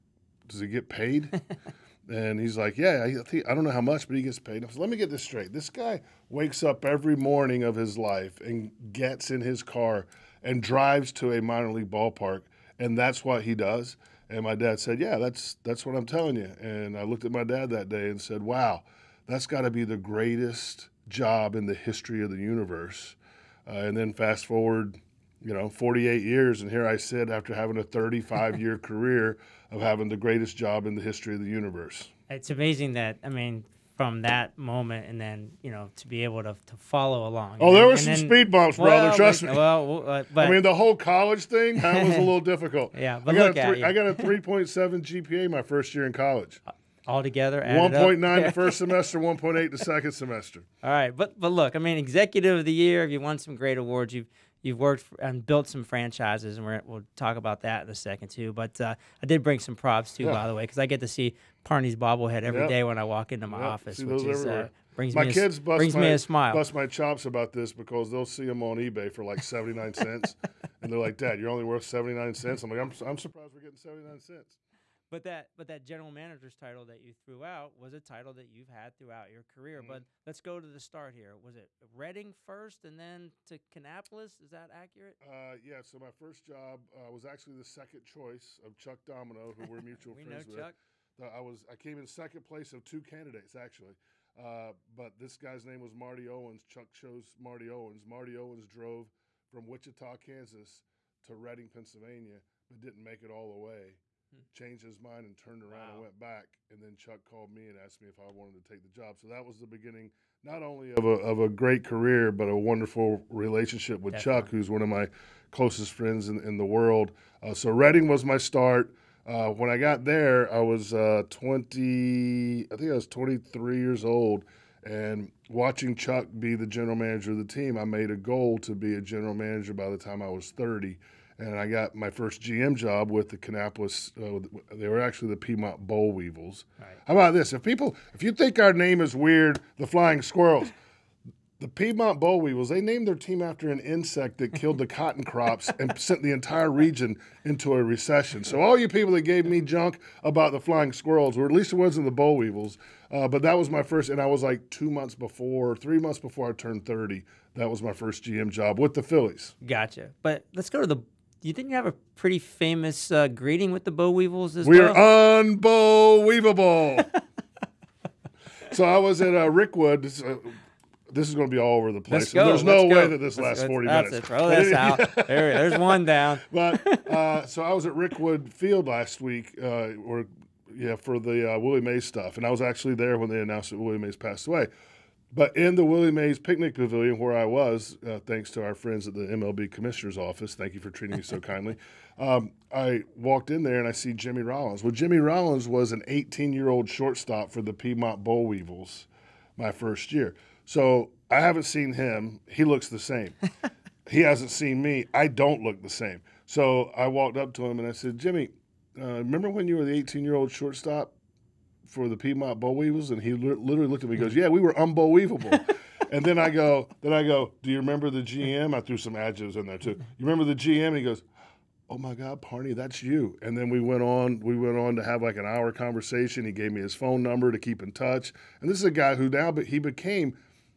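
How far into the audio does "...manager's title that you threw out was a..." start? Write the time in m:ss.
1:16.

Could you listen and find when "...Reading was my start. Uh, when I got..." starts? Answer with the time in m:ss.
1:57.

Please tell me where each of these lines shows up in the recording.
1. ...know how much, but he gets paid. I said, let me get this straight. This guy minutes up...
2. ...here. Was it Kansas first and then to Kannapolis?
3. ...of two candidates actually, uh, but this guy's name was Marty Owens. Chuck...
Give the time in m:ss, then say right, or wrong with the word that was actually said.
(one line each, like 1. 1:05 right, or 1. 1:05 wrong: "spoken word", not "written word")
1. 0:03 wrong: "wakes", not "minutes"
2. 1:21 wrong: "Reading", not "Kansas"
3. 1:32 right.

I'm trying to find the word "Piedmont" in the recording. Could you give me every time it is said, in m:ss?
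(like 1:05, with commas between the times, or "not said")
2:15, 2:21, 3:17, 3:32.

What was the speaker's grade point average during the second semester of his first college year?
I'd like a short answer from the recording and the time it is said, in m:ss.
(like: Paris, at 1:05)
1.8, at 0:49.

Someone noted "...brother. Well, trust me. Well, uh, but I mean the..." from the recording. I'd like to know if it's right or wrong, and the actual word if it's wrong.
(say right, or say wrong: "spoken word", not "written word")
right.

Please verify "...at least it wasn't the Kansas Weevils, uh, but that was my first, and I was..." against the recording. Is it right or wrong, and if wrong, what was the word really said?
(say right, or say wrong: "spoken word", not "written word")
wrong: "Boll", not "Kansas".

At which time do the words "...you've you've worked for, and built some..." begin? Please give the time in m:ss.
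0:54.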